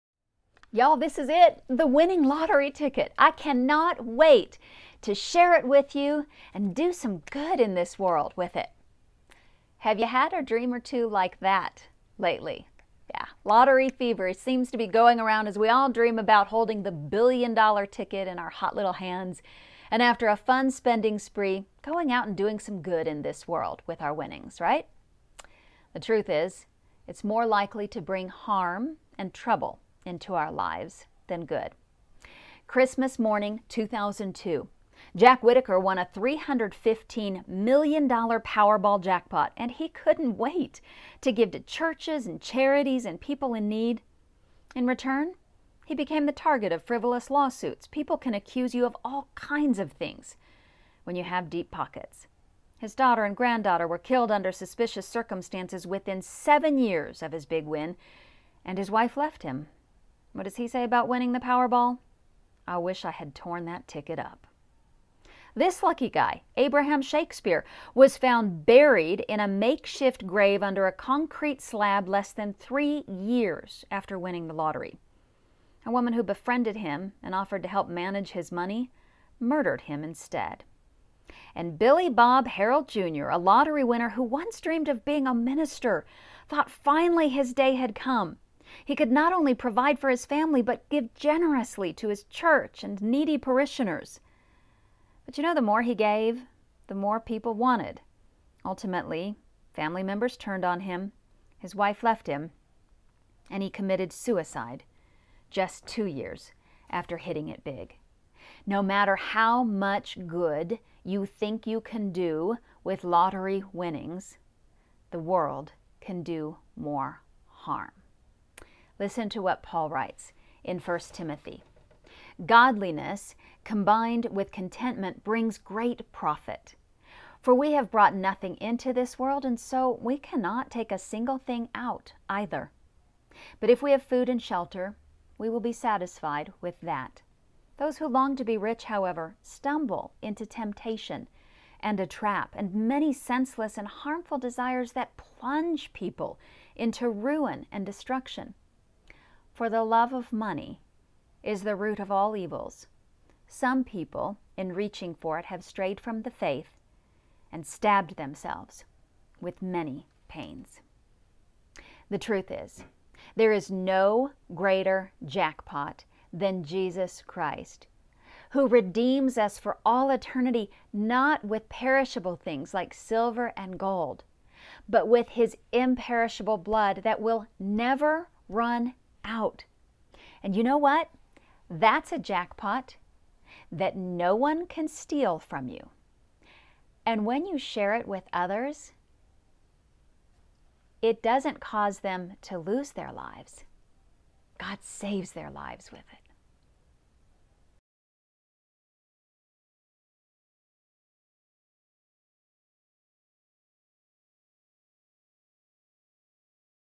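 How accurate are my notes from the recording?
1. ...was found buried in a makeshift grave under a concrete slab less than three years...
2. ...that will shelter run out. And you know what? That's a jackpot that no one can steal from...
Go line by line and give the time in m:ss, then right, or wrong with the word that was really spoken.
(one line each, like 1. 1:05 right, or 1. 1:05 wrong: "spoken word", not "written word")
1. 1:07 right
2. 2:57 wrong: "never", not "shelter".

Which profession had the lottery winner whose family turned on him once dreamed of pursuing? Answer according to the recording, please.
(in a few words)
Minister.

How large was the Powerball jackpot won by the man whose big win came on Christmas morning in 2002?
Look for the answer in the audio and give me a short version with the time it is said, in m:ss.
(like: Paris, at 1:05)
$315 million, at 0:36.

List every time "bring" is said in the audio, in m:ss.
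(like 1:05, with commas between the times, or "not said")
0:28, 2:05.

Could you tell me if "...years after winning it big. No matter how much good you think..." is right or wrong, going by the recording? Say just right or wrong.
wrong.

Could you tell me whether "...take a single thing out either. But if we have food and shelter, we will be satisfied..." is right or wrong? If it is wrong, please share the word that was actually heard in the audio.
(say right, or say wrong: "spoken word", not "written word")
right.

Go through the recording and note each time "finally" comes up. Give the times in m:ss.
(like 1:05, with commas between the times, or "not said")
1:26.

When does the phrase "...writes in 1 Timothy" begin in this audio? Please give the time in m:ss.
1:59.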